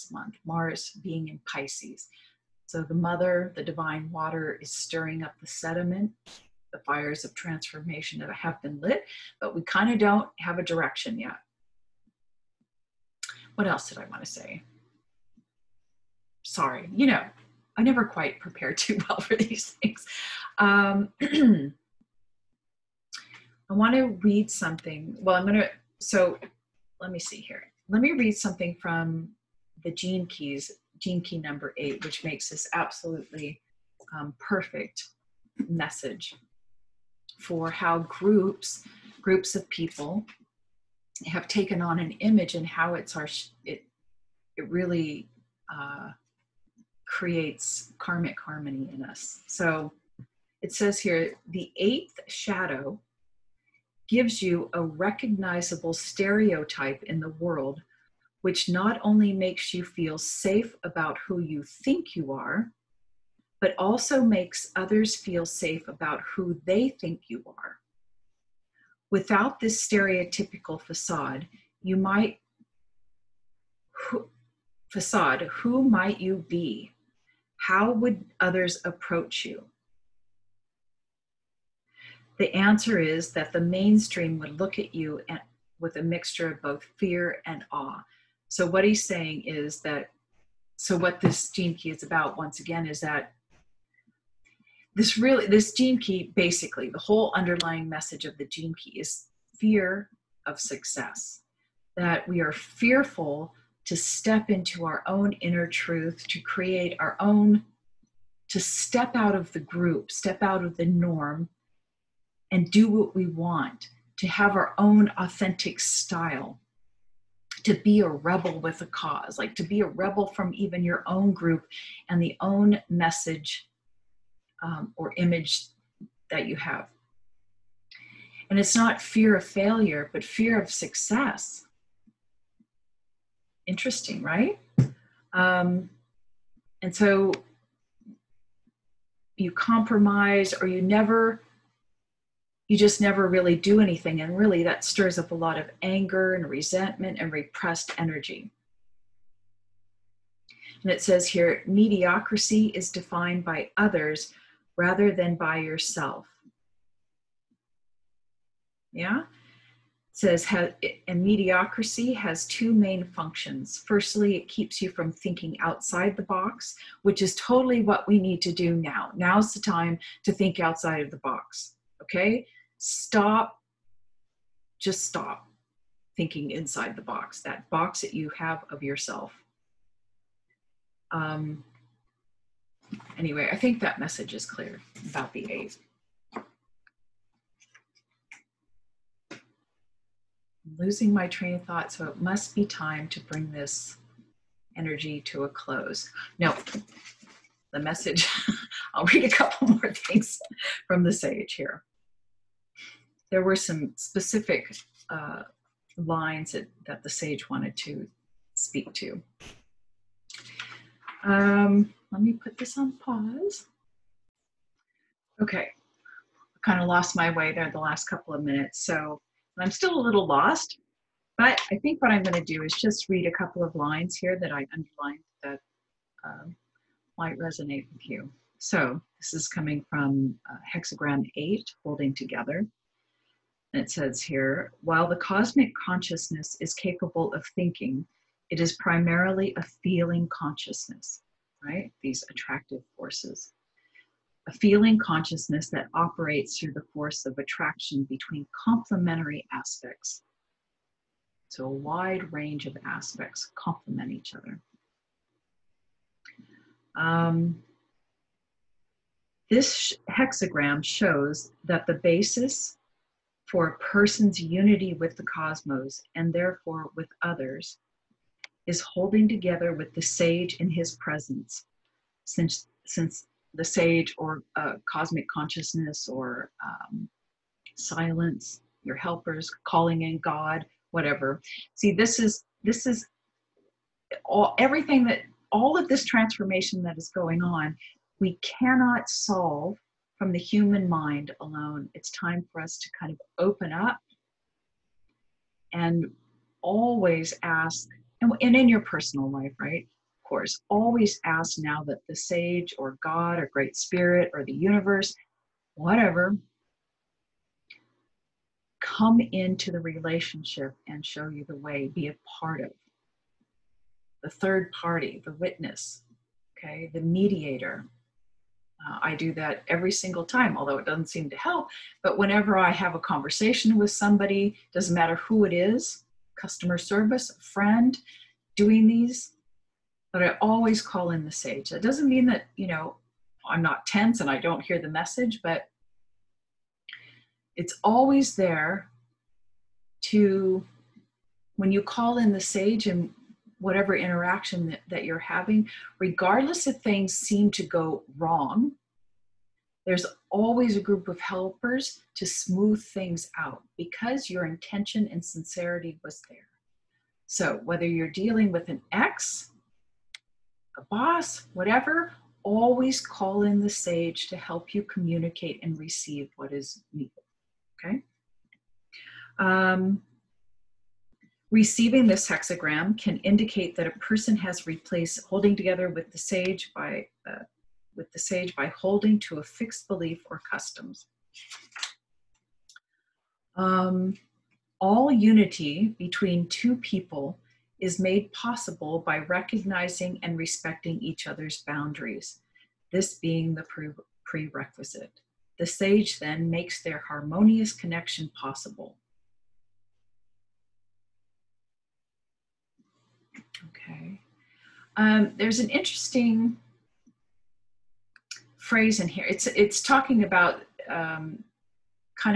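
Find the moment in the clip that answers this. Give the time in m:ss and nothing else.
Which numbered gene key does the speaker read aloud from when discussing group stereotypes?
0:30.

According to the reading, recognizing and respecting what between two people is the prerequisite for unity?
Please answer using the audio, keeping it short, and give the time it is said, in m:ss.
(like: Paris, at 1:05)
Each other's boundaries, at 6:31.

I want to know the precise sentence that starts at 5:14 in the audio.
The third party, the witness, okay, the mediator.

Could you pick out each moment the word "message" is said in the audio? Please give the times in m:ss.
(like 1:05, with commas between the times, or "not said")
0:35, 1:37, 2:02, 3:03, 3:17, 5:34.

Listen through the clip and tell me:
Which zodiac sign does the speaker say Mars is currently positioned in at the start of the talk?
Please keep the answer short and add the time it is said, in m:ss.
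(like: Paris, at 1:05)
Pisces, at 0:01.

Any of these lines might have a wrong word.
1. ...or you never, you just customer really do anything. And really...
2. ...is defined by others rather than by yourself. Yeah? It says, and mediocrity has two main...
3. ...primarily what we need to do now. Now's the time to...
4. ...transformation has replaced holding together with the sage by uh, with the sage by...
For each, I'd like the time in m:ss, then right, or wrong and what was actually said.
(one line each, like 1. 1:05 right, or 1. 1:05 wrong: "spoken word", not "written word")
1. 2:20 wrong: "never", not "customer"
2. 2:32 right
3. 2:47 wrong: "totally", not "primarily"
4. 6:13 wrong: "person", not "transformation".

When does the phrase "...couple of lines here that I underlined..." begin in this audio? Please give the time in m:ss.
3:43.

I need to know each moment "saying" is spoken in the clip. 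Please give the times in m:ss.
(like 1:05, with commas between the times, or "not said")
1:29.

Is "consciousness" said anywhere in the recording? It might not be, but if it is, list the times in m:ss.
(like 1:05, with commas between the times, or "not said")
3:55, 4:00, 4:04, 4:35.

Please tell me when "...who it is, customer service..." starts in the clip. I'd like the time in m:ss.
5:25.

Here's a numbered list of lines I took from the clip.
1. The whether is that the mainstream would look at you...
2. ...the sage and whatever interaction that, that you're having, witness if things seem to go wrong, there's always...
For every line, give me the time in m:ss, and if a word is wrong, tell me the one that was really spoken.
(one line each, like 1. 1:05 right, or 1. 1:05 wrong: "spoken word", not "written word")
1. 1:22 wrong: "answer", not "whether"
2. 5:42 wrong: "regardless", not "witness".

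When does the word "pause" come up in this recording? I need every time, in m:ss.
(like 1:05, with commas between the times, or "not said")
3:32.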